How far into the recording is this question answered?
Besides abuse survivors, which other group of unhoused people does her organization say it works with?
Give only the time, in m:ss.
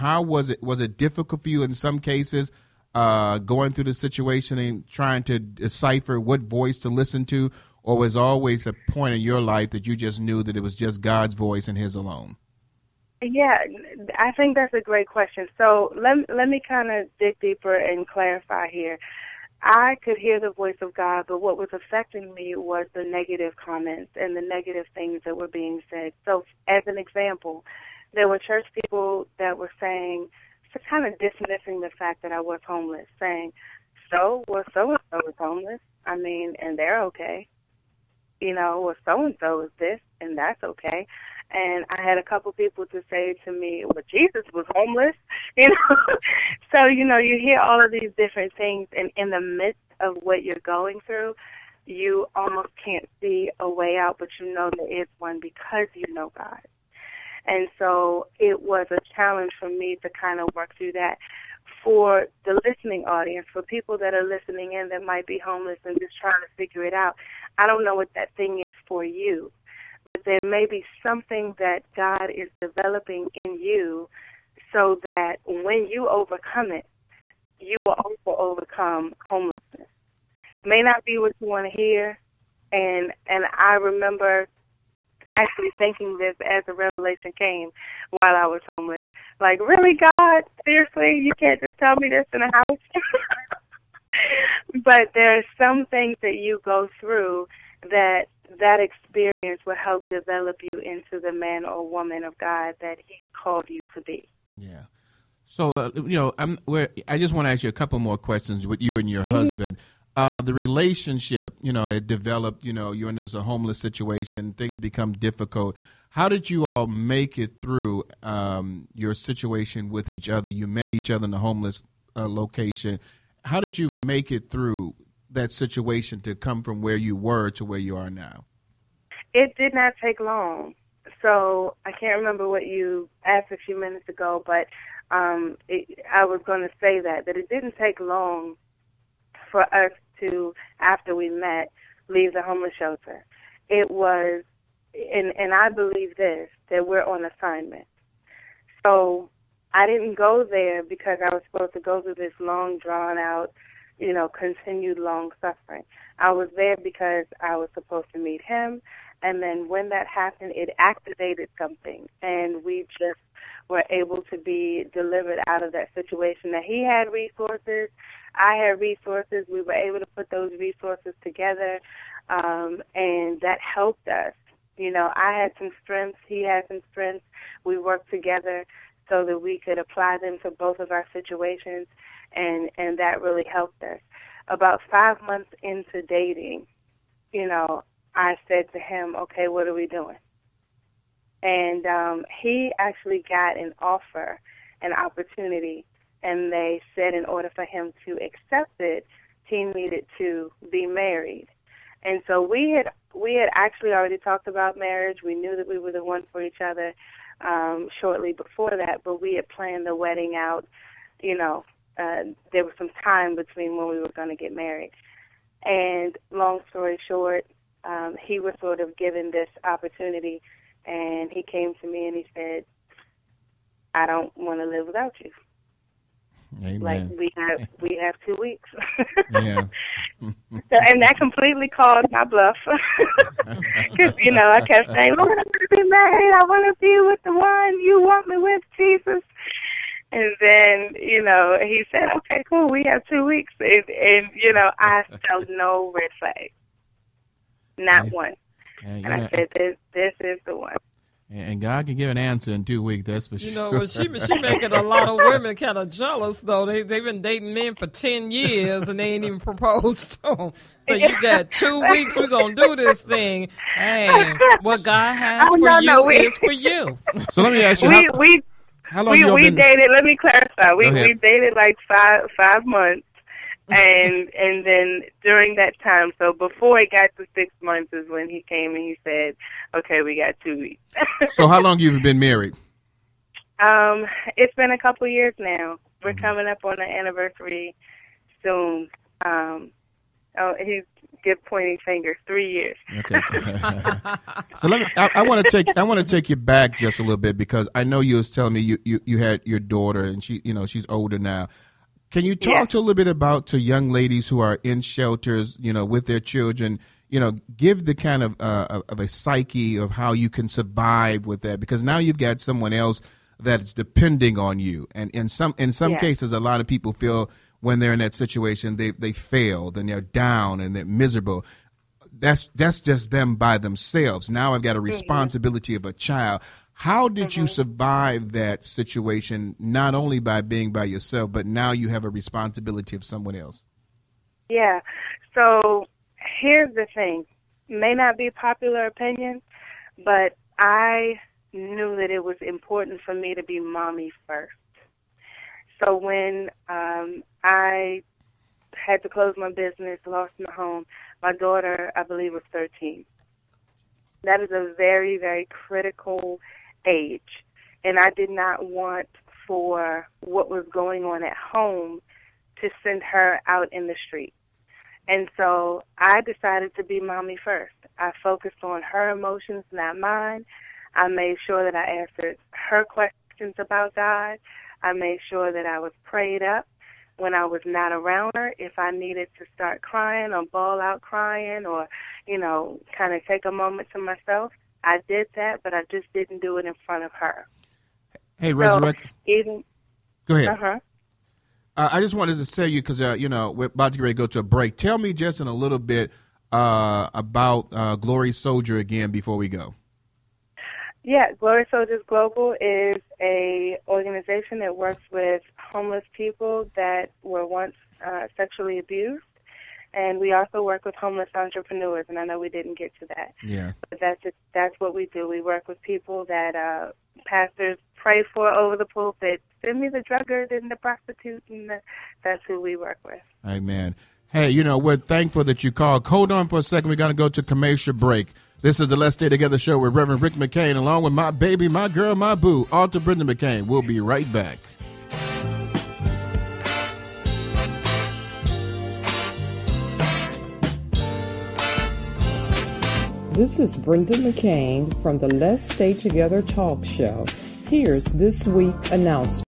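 6:50.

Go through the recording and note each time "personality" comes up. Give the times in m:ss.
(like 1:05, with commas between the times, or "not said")
not said.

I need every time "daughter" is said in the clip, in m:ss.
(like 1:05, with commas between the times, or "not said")
4:59, 5:51.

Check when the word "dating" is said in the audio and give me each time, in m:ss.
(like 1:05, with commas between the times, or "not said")
3:06, 4:17.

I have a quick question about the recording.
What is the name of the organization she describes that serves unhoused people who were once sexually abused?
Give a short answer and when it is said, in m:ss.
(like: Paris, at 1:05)
Glory Soldiers Global, at 6:41.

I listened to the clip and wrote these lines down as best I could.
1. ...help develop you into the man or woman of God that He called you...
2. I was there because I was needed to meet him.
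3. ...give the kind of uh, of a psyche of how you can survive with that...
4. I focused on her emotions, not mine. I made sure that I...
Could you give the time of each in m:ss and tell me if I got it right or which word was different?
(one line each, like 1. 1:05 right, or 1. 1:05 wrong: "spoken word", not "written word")
1. 1:39 right
2. 2:36 wrong: "supposed", not "needed"
3. 5:07 right
4. 6:07 right.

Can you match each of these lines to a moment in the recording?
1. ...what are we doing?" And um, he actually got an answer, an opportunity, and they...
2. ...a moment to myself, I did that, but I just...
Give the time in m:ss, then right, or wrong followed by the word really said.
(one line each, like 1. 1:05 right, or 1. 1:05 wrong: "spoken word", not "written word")
1. 3:09 wrong: "offer", not "answer"
2. 6:23 right.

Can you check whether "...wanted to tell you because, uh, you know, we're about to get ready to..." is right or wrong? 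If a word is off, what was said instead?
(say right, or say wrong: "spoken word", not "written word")
right.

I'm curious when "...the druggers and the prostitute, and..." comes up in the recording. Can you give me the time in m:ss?
6:59.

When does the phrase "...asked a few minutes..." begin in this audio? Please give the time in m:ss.
2:13.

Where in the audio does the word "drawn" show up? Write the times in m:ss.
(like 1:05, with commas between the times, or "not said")
2:32.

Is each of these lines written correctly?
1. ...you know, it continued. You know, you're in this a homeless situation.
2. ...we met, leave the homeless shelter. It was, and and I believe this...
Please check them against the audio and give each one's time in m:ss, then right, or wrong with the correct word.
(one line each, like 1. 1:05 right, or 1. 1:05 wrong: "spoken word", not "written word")
1. 1:51 wrong: "developed", not "continued"
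2. 2:21 right.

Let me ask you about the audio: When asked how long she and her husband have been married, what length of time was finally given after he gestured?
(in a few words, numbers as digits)
3 years.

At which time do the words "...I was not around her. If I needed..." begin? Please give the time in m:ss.
6:17.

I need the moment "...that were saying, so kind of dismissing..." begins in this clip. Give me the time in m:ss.
0:29.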